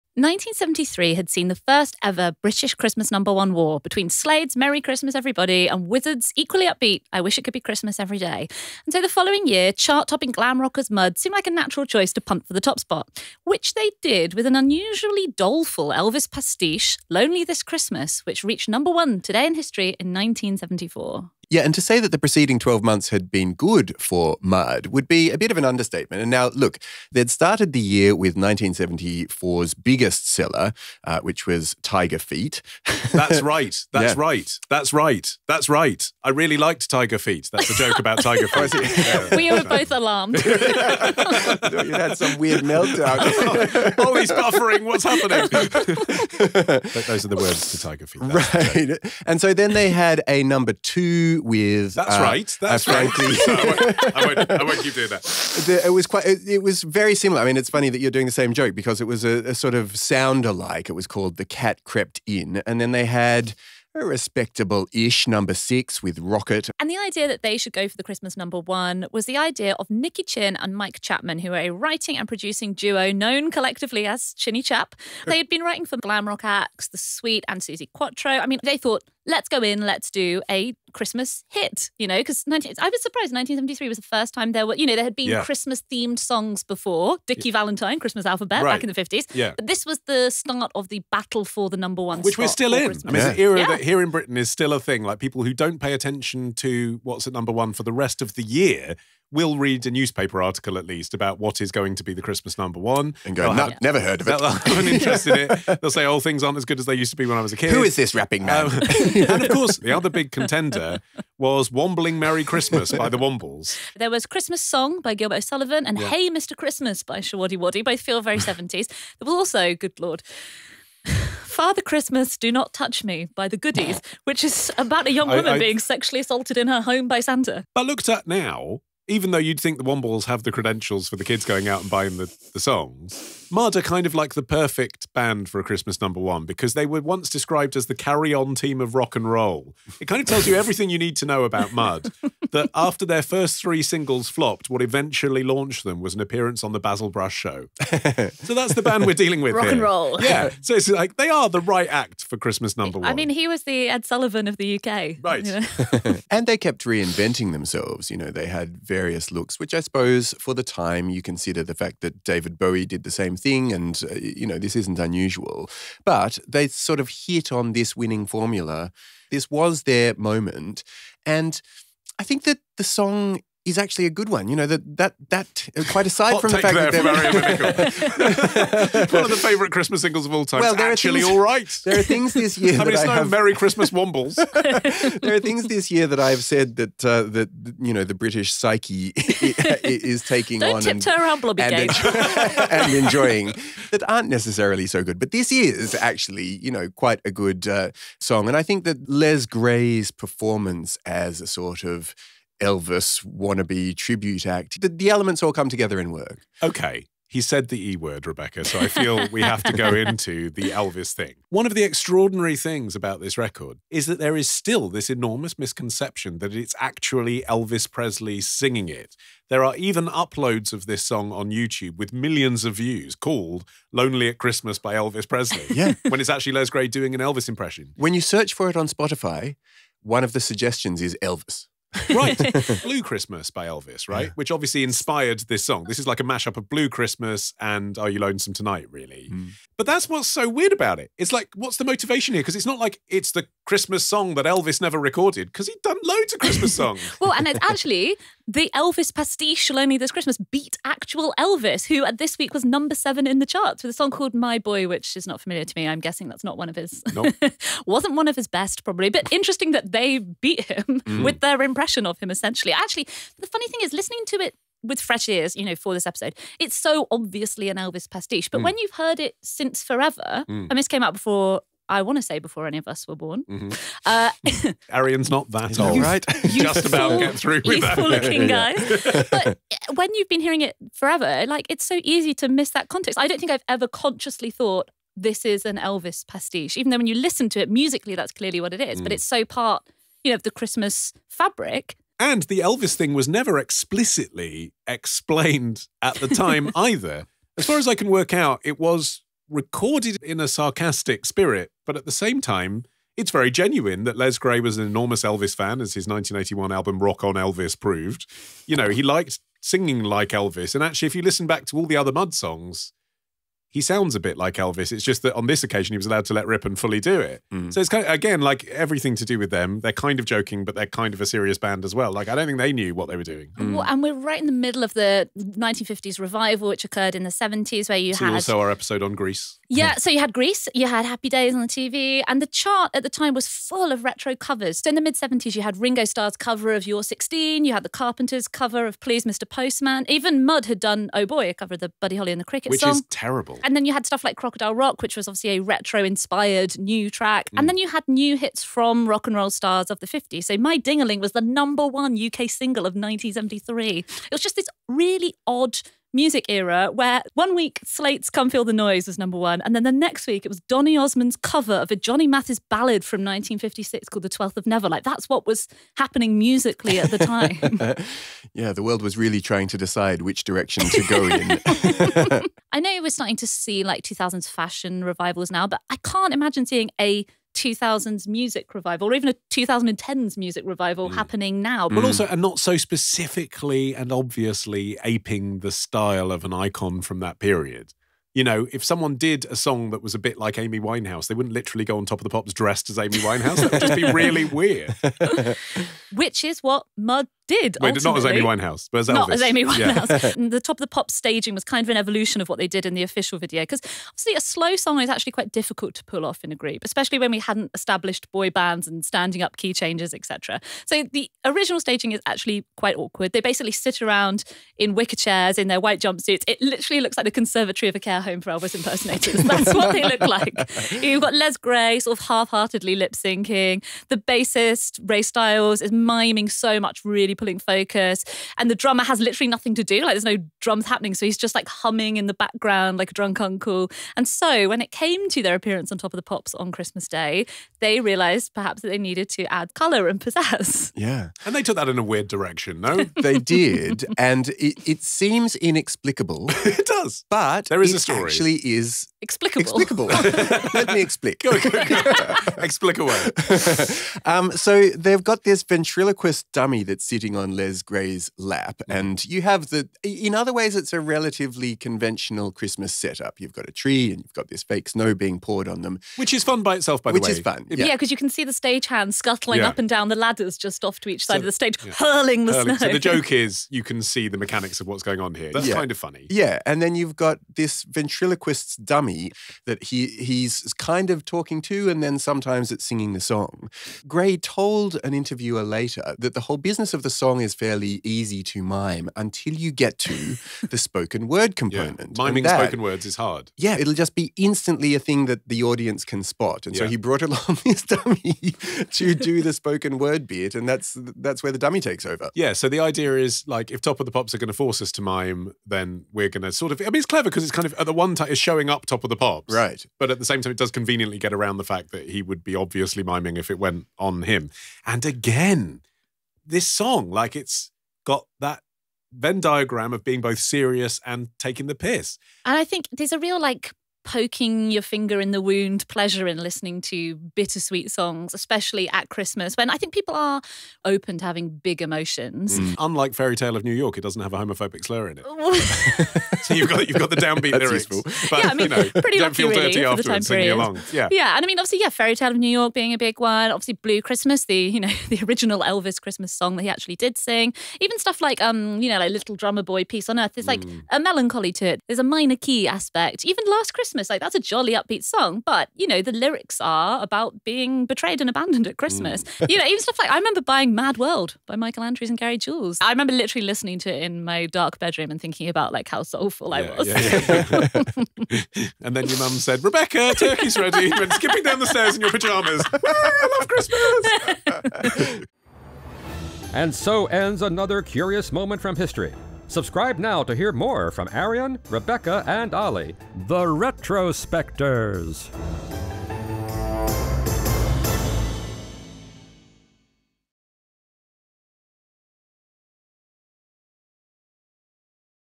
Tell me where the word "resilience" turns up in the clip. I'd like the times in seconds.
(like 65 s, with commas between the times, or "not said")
not said.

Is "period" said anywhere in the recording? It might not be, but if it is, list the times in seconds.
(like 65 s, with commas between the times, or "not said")
387 s, 540 s.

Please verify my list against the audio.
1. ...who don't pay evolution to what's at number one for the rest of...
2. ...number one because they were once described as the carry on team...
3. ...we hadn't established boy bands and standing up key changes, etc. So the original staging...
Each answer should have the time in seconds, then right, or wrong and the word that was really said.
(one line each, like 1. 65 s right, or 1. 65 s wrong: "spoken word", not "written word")
1. 95 s wrong: "attention", not "evolution"
2. 135 s right
3. 407 s right.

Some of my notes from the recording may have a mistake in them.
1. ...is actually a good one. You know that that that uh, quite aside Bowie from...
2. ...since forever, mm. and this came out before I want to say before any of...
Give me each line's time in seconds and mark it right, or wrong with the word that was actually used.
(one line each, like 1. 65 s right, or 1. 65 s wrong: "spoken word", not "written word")
1. 173 s wrong: "Hot", not "Bowie"
2. 269 s right.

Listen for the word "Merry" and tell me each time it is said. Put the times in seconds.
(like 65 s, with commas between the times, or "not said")
4 s, 112 s, 183 s.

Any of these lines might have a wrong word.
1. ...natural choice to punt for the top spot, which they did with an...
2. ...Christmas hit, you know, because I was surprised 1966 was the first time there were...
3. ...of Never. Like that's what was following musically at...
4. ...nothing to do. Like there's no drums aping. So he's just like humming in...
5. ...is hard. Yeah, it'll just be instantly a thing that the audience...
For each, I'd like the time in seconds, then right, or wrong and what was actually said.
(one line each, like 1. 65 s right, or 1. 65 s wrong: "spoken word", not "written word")
1. 11 s right
2. 80 s wrong: "1973", not "1966"
3. 364 s wrong: "happening", not "following"
4. 429 s wrong: "happening", not "aping"
5. 493 s right.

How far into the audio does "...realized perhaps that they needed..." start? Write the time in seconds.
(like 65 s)
438 s.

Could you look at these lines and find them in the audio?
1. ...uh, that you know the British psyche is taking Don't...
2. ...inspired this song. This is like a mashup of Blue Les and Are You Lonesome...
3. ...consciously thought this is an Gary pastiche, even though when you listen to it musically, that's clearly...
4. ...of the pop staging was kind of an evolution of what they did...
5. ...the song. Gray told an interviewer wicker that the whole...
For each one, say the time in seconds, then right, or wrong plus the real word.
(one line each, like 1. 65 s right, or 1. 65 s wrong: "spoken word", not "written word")
1. 187 s right
2. 234 s wrong: "Christmas", not "Les"
3. 283 s wrong: "Elvis", not "Gary"
4. 400 s right
5. 483 s wrong: "later", not "wicker".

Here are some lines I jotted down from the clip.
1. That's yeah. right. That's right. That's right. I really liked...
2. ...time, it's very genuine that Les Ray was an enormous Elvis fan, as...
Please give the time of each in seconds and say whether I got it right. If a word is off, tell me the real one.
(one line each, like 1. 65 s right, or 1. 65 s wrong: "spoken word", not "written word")
1. 33 s right
2. 302 s wrong: "Gray", not "Ray".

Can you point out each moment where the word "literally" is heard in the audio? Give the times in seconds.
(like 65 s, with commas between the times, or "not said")
391 s, 416 s, 429 s, 563 s.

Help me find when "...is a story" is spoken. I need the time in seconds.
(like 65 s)
447 s.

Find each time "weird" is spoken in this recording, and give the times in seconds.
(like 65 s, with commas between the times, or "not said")
42 s, 240 s, 394 s, 442 s.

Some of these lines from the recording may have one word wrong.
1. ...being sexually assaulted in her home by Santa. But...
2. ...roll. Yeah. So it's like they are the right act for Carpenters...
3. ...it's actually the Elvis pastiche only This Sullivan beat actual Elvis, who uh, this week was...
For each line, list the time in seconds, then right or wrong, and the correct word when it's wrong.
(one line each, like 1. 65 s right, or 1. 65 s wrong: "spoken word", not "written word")
1. 125 s right
2. 149 s wrong: "Christmas", not "Carpenters"
3. 247 s wrong: "Christmas", not "Sullivan".